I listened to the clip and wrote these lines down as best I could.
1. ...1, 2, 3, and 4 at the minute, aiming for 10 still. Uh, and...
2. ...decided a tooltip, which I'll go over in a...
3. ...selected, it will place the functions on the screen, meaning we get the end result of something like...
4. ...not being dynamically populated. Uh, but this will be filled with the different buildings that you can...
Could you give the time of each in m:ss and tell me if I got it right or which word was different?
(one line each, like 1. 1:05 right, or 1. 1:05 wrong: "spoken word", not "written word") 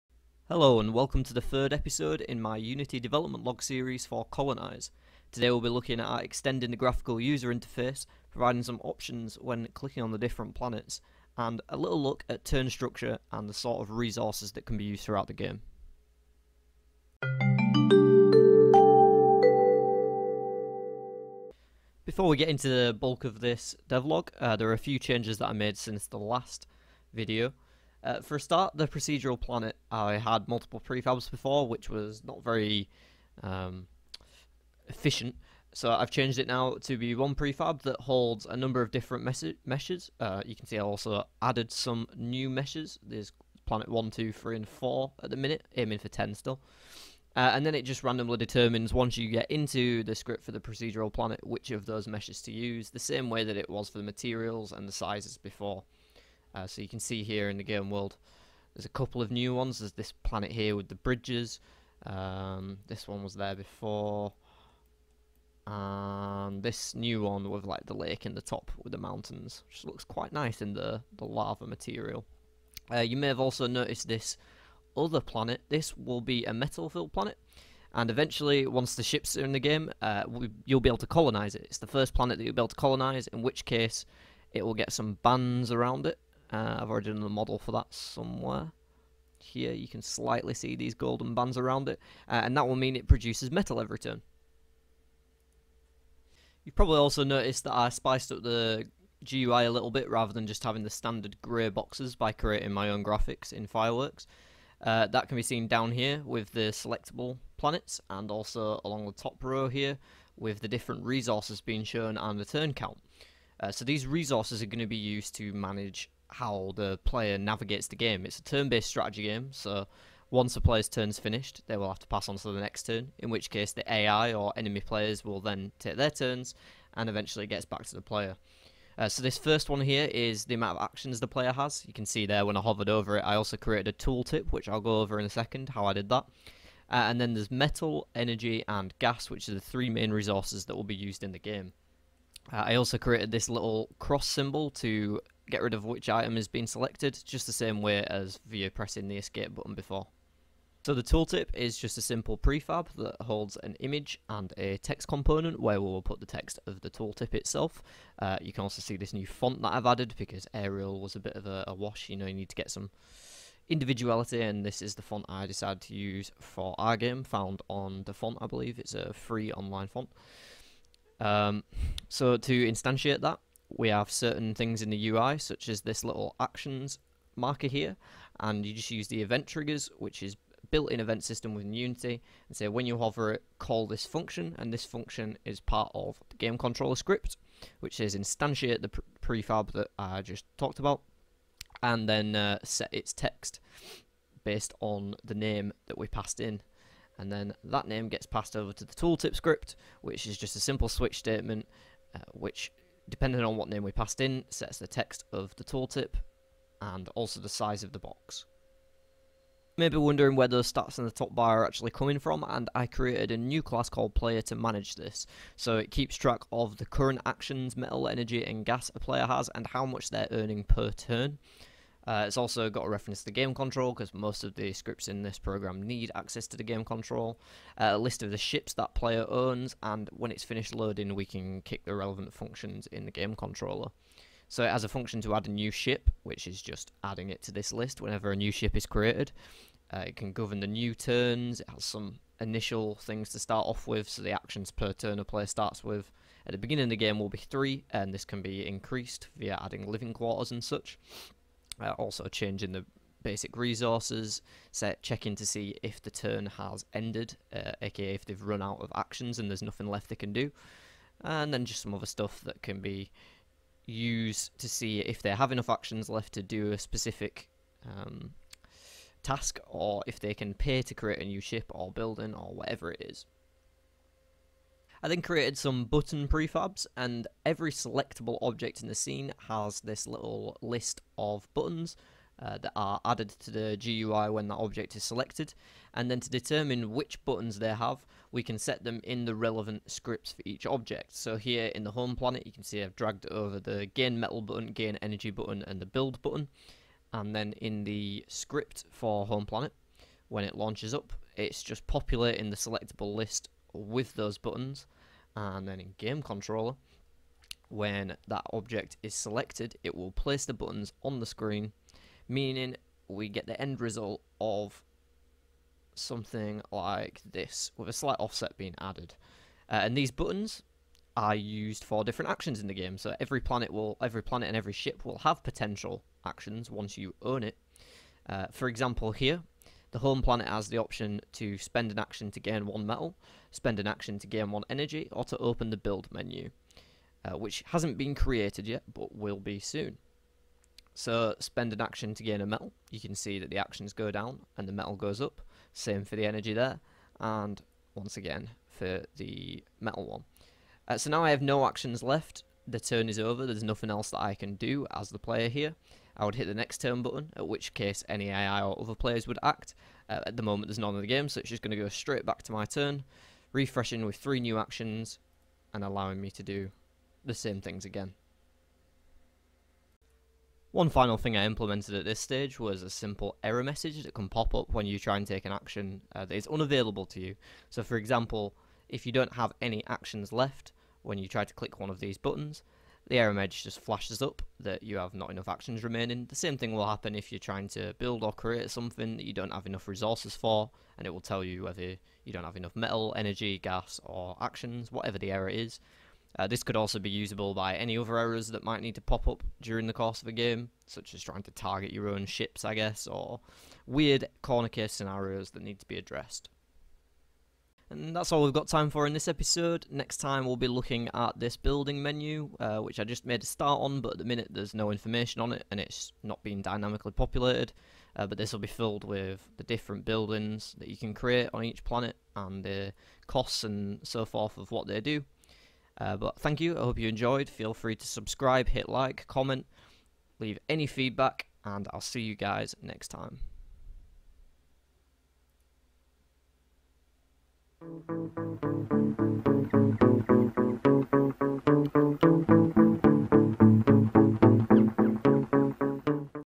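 1. 0:43 right
2. 2:13 wrong: "created", not "decided"
3. 5:09 wrong: "buttons", not "functions"
4. 6:56 right.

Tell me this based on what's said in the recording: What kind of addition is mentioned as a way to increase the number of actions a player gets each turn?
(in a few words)
living quarters.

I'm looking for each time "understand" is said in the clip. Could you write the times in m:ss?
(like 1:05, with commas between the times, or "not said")
not said.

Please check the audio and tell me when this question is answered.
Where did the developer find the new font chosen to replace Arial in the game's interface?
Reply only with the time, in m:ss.
2:48.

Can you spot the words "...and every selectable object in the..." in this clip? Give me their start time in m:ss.
4:36.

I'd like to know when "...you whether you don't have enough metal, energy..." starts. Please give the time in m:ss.
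6:31.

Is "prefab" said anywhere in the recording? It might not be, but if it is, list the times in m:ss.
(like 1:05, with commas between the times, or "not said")
0:30, 0:37, 2:32, 3:09, 4:36.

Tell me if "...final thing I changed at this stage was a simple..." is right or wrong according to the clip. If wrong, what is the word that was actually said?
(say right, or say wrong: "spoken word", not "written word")
wrong: "implemented", not "changed".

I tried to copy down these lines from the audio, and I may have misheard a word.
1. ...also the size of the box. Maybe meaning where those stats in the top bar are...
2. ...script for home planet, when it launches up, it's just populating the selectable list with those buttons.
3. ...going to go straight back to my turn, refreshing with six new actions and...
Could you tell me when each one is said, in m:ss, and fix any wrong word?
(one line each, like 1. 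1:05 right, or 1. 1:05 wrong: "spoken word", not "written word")
1. 3:27 wrong: "wondering", not "meaning"
2. 4:58 right
3. 6:01 wrong: "three", not "six".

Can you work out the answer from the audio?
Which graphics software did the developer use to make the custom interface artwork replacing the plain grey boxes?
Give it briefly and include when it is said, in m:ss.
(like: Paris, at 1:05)
Fireworks, at 1:43.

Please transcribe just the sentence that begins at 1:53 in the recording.
Uh, so these resources are going to be used to manage how the player navigates the game.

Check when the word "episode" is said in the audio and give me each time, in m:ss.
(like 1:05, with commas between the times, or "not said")
0:01, 6:49.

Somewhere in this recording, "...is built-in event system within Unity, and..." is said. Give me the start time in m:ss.
3:00.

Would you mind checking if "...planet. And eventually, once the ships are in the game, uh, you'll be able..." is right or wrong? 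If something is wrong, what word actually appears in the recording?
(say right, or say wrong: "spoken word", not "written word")
right.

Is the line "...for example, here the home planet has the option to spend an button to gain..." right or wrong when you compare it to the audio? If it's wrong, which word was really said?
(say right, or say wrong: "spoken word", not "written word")
wrong: "action", not "button".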